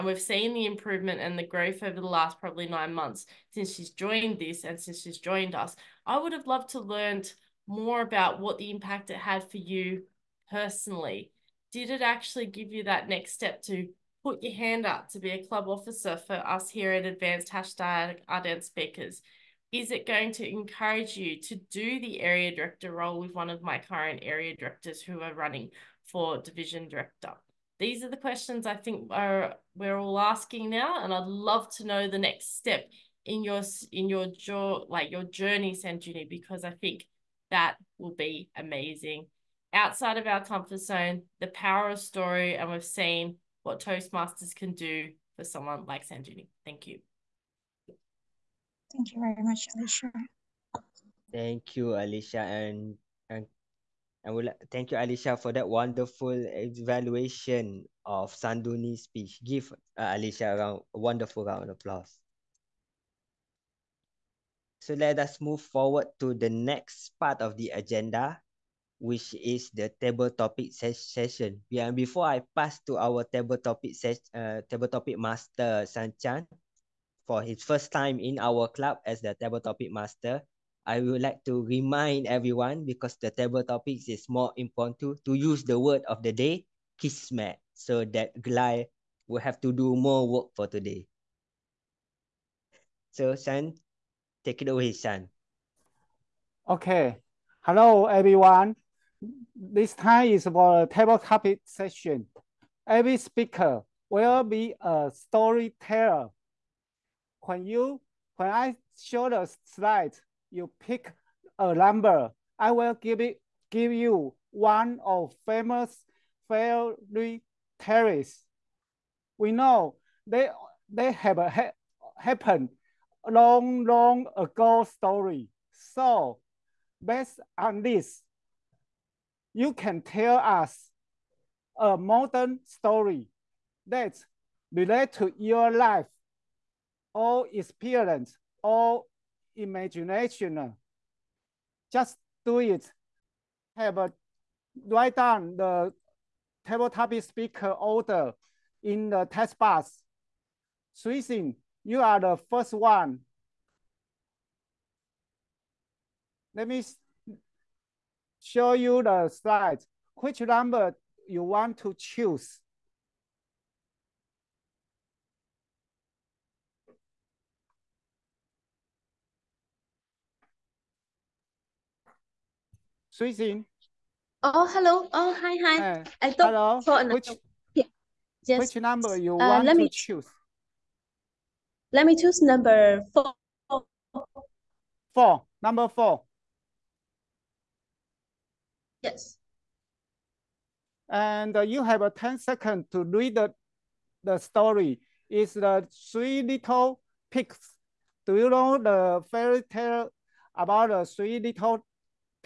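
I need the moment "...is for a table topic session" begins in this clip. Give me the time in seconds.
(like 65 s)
100 s.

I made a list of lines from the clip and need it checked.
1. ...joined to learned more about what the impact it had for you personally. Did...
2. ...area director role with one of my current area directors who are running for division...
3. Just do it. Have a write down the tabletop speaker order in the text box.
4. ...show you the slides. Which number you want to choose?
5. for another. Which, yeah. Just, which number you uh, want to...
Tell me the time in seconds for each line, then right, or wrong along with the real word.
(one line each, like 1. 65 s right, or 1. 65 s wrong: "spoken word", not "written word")
1. 6 s wrong: "loved", not "joined"
2. 22 s right
3. 141 s right
4. 158 s right
5. 176 s right.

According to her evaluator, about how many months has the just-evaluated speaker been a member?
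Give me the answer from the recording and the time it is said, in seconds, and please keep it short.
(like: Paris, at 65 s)
9, at 2 s.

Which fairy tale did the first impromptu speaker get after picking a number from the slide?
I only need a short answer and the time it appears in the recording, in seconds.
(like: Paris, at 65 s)
The Three Little Pigs, at 195 s.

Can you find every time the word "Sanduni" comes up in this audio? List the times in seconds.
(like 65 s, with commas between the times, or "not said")
35 s, 46 s, 58 s.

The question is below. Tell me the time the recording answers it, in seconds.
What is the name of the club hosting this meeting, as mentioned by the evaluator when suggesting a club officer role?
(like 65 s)
17 s.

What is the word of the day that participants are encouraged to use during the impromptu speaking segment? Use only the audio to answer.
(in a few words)
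kismet.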